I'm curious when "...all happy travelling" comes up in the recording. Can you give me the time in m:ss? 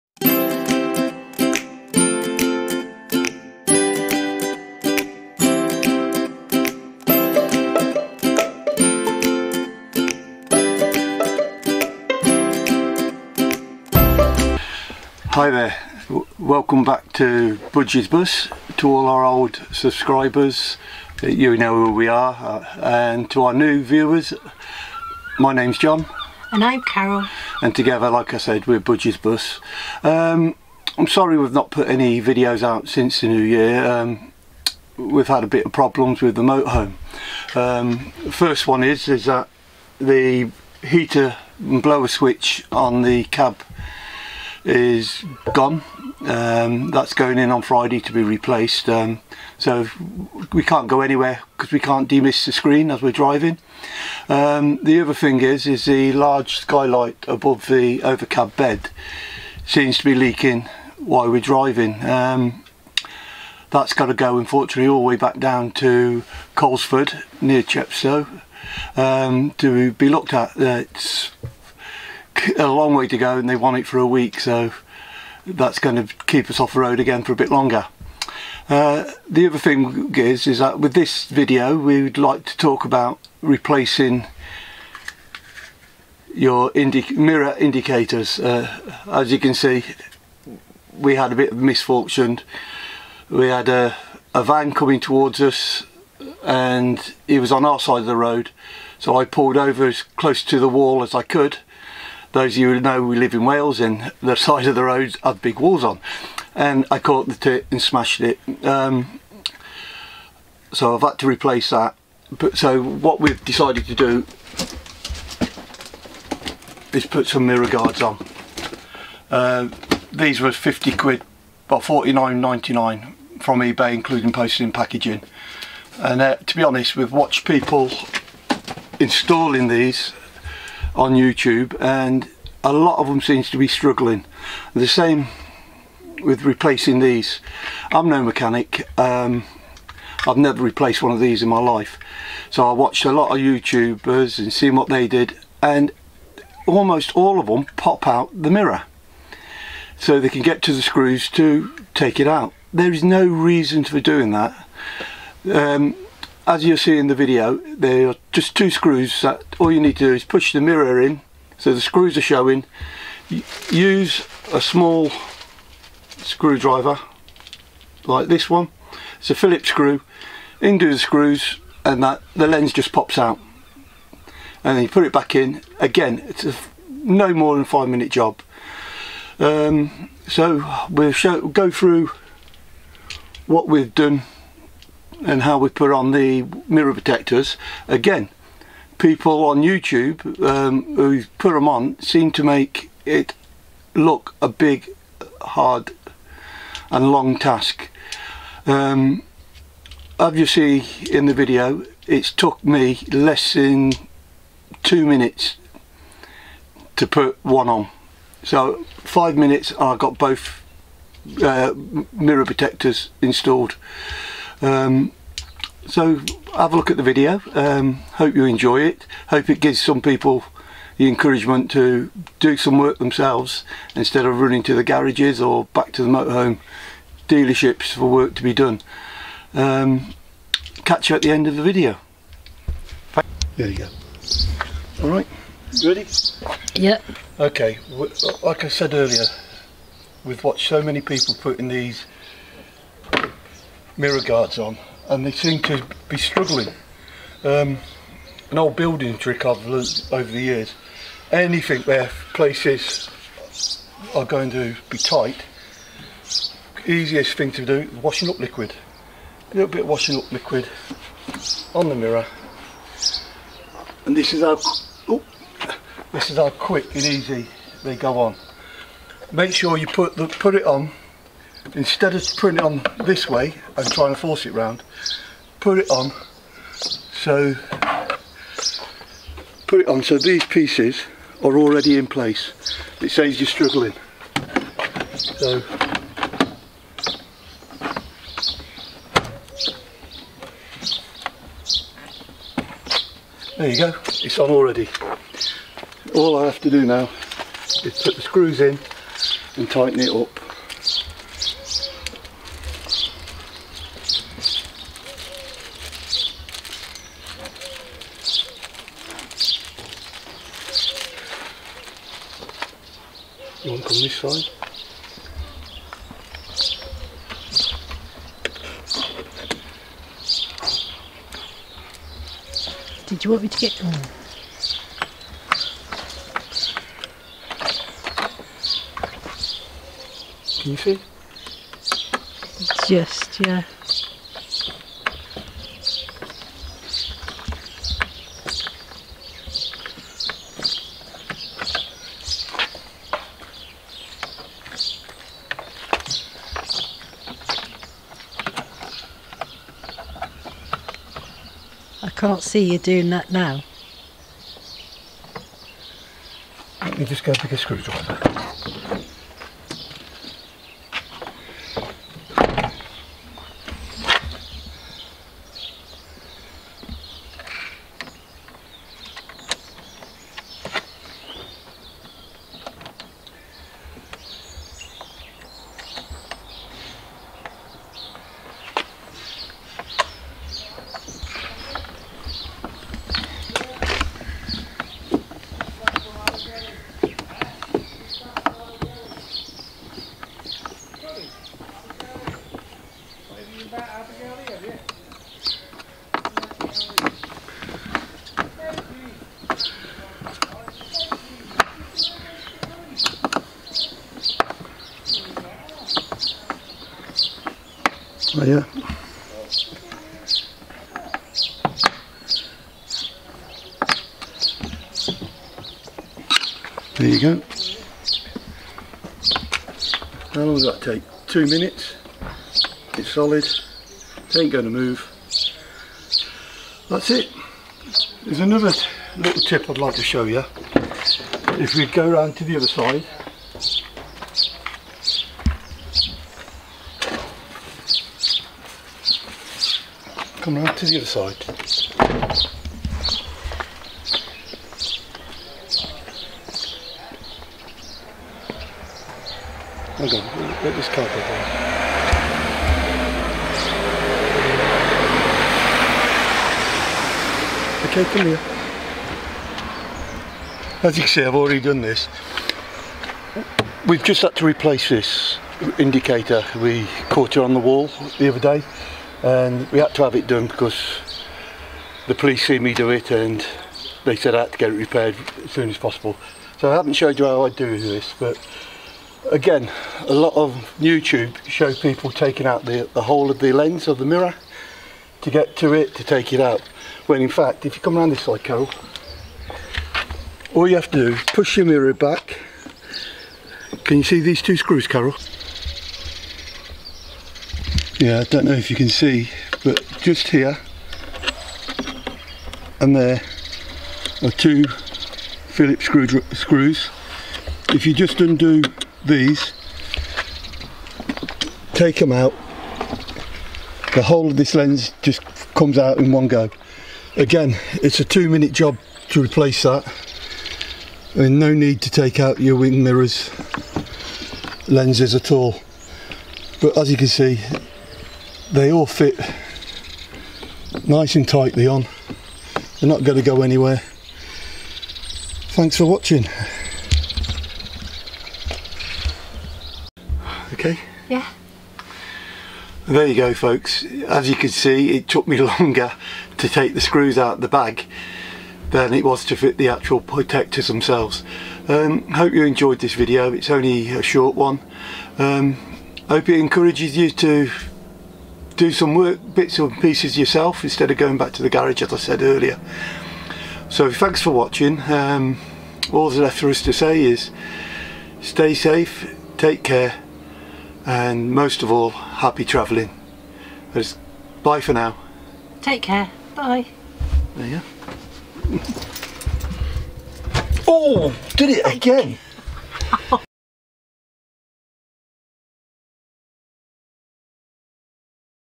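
9:31.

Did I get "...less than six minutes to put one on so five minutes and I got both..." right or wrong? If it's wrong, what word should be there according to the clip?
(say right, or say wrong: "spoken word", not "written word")
wrong: "two", not "six".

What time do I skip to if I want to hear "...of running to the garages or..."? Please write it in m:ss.
3:44.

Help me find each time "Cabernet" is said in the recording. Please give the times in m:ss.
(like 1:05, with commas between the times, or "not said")
not said.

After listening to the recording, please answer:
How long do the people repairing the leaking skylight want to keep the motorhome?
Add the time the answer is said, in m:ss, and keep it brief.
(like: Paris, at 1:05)
A week, at 1:13.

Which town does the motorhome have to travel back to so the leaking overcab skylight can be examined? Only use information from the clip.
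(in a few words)
Coleford.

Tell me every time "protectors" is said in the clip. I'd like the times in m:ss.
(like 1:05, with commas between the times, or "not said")
3:06, 3:32, 9:10.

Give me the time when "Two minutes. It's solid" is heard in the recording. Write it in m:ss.
7:01.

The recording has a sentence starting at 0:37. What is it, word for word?
Um, first one is, is that the heater and blower switch on the cab is gone.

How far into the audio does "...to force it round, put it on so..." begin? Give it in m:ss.
4:34.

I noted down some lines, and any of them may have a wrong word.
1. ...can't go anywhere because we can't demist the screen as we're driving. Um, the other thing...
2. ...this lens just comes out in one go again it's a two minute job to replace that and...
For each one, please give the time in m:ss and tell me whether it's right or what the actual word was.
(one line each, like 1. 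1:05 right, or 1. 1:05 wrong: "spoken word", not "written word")
1. 0:50 right
2. 8:34 right.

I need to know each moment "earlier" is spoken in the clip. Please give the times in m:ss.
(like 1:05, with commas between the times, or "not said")
3:58, 9:22.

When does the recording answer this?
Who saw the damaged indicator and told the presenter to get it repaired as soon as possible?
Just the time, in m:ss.
7:52.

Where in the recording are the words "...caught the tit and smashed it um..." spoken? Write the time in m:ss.
1:46.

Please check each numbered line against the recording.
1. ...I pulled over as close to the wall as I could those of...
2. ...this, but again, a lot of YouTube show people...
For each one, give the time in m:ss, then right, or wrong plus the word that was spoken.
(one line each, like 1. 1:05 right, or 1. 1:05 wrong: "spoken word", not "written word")
1. 1:39 right
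2. 7:57 right.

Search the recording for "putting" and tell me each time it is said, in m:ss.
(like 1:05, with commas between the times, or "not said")
4:01, 4:32.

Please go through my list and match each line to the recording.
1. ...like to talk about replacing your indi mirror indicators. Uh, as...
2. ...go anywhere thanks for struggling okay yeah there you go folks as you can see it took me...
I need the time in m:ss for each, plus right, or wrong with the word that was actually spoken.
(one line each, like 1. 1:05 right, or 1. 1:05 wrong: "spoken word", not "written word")
1. 1:22 right
2. 8:53 wrong: "watching", not "struggling".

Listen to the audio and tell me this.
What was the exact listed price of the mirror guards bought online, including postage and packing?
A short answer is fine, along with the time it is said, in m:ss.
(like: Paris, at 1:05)
£49.99, at 2:01.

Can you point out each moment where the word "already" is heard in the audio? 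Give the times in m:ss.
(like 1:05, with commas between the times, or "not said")
4:41, 4:54, 7:41.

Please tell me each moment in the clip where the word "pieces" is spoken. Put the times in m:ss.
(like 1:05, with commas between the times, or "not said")
4:40, 9:19.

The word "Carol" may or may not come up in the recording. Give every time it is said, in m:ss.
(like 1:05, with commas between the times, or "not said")
0:26, 8:08, 8:14.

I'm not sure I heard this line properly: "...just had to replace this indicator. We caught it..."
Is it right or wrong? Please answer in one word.
right.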